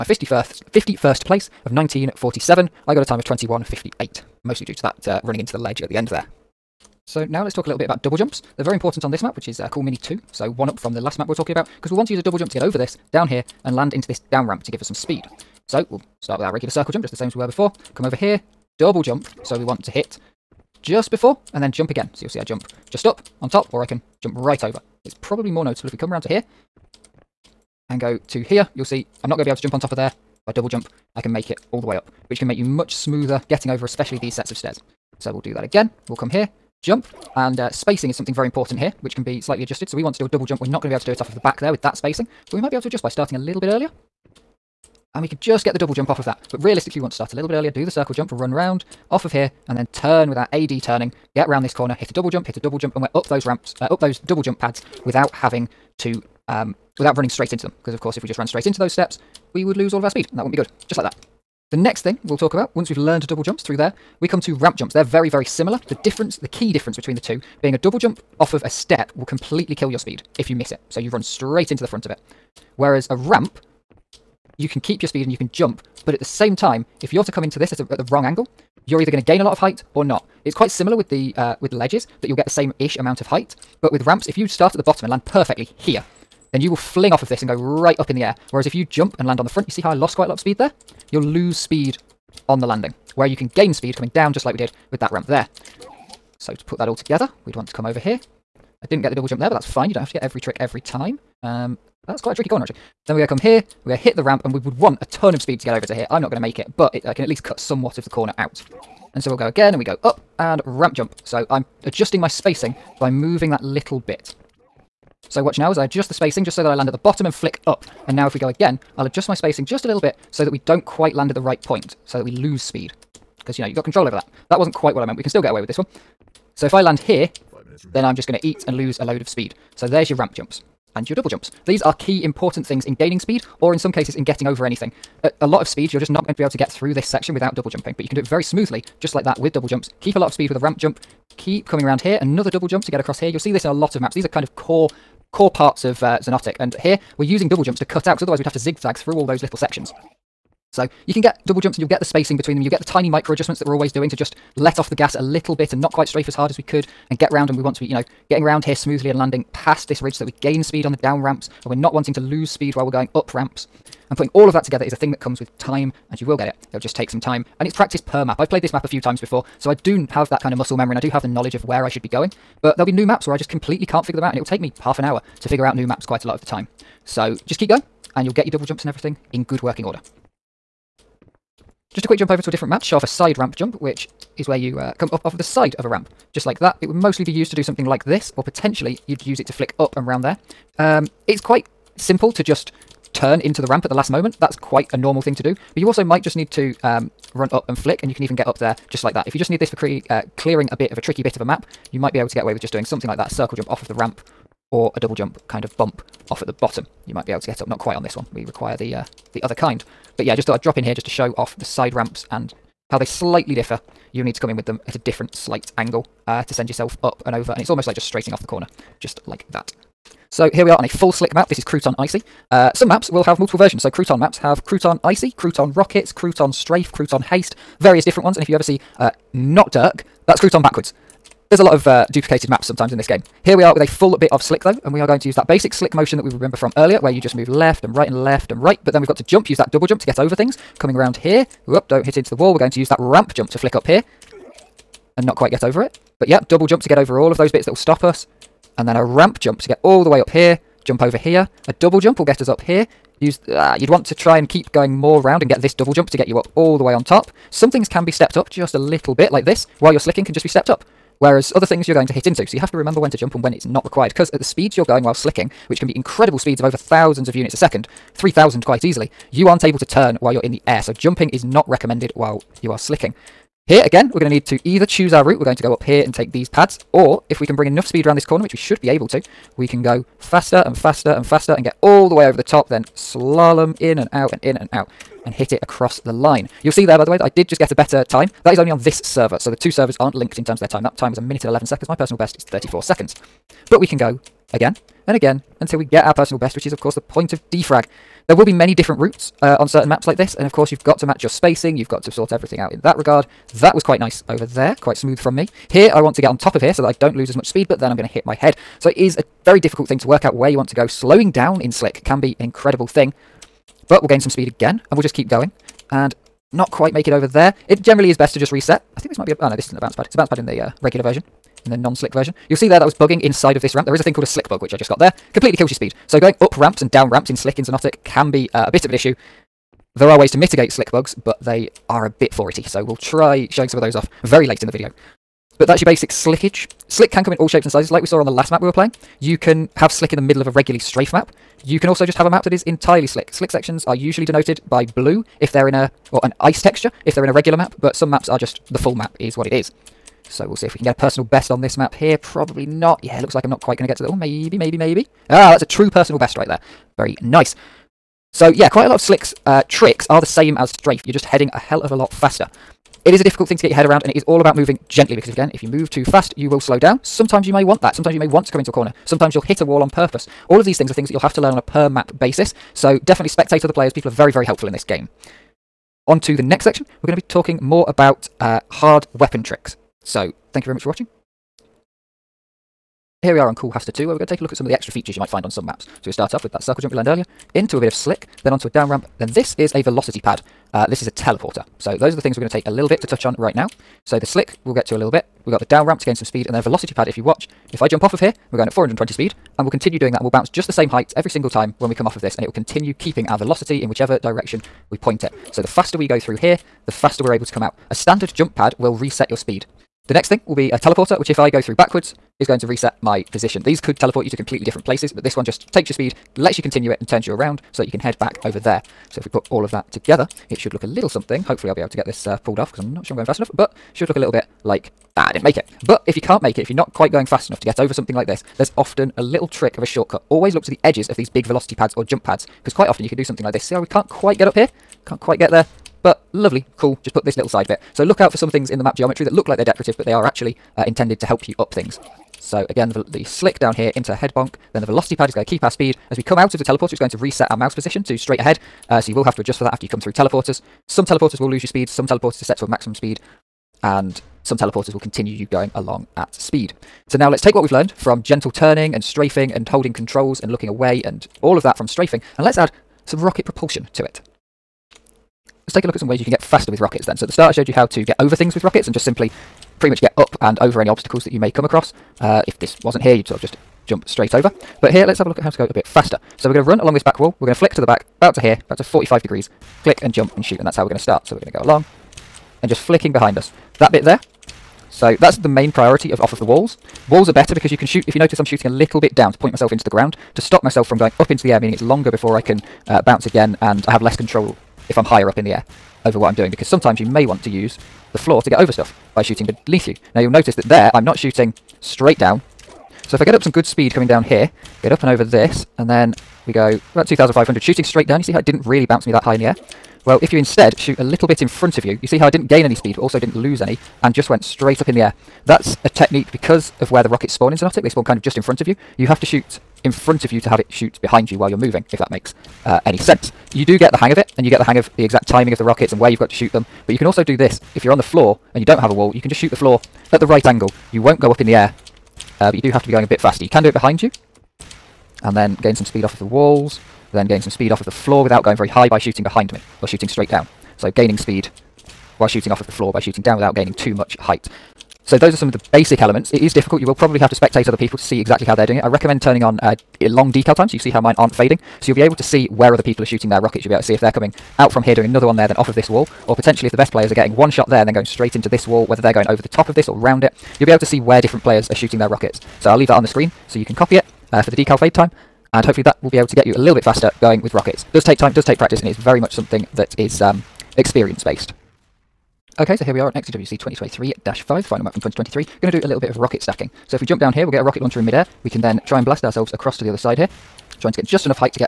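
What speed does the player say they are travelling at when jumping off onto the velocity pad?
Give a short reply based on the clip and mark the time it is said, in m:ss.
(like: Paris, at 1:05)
420, at 6:38.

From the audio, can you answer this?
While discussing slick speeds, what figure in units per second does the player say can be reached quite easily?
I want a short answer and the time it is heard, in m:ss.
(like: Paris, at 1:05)
3000, at 4:28.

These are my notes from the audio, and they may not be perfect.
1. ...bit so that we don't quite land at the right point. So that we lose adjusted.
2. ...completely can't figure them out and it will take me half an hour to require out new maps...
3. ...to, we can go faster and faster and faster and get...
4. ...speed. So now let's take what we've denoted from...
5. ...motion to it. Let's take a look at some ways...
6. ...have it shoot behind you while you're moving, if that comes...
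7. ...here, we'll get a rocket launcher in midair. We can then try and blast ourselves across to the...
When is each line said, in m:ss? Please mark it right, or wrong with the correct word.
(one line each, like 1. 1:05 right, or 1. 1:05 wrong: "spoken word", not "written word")
1. 1:59 wrong: "speed", not "adjusted"
2. 2:53 wrong: "figure", not "require"
3. 4:39 right
4. 7:36 wrong: "learned", not "denoted"
5. 7:43 wrong: "propulsion", not "motion"
6. 8:40 wrong: "makes", not "comes"
7. 9:37 right.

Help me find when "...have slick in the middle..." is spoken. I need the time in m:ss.
5:39.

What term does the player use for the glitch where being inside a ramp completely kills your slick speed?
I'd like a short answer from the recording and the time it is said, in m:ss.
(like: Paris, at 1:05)
slick bug, at 5:24.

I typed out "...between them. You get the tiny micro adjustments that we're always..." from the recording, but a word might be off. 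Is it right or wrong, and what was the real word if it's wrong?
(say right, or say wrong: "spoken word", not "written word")
right.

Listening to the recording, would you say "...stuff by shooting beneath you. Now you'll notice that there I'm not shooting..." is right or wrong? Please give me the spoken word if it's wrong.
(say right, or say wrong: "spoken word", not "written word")
right.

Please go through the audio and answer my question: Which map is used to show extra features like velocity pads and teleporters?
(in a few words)
Cool Haster 2.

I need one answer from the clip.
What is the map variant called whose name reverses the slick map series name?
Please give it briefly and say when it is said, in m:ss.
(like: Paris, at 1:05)
Not Dirk, at 3:49.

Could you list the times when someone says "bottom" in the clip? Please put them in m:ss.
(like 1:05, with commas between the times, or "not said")
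1:24, 1:56, 3:26.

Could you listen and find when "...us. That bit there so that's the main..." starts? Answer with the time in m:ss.
8:03.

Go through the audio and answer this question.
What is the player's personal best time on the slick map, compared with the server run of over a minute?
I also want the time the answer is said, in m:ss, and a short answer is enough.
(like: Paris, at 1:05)
34 seconds, at 4:52.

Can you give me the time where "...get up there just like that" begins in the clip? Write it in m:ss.
3:18.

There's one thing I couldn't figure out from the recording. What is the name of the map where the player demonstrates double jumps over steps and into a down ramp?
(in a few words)
Cool Mini 2.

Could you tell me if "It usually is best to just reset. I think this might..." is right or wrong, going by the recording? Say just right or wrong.
wrong.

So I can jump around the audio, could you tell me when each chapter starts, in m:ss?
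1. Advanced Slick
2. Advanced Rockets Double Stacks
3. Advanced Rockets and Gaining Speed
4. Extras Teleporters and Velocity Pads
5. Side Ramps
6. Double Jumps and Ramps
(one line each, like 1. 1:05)
1. 3:39
2. 9:31
3. 7:44
4. 6:22
5. 3:00
6. 0:06.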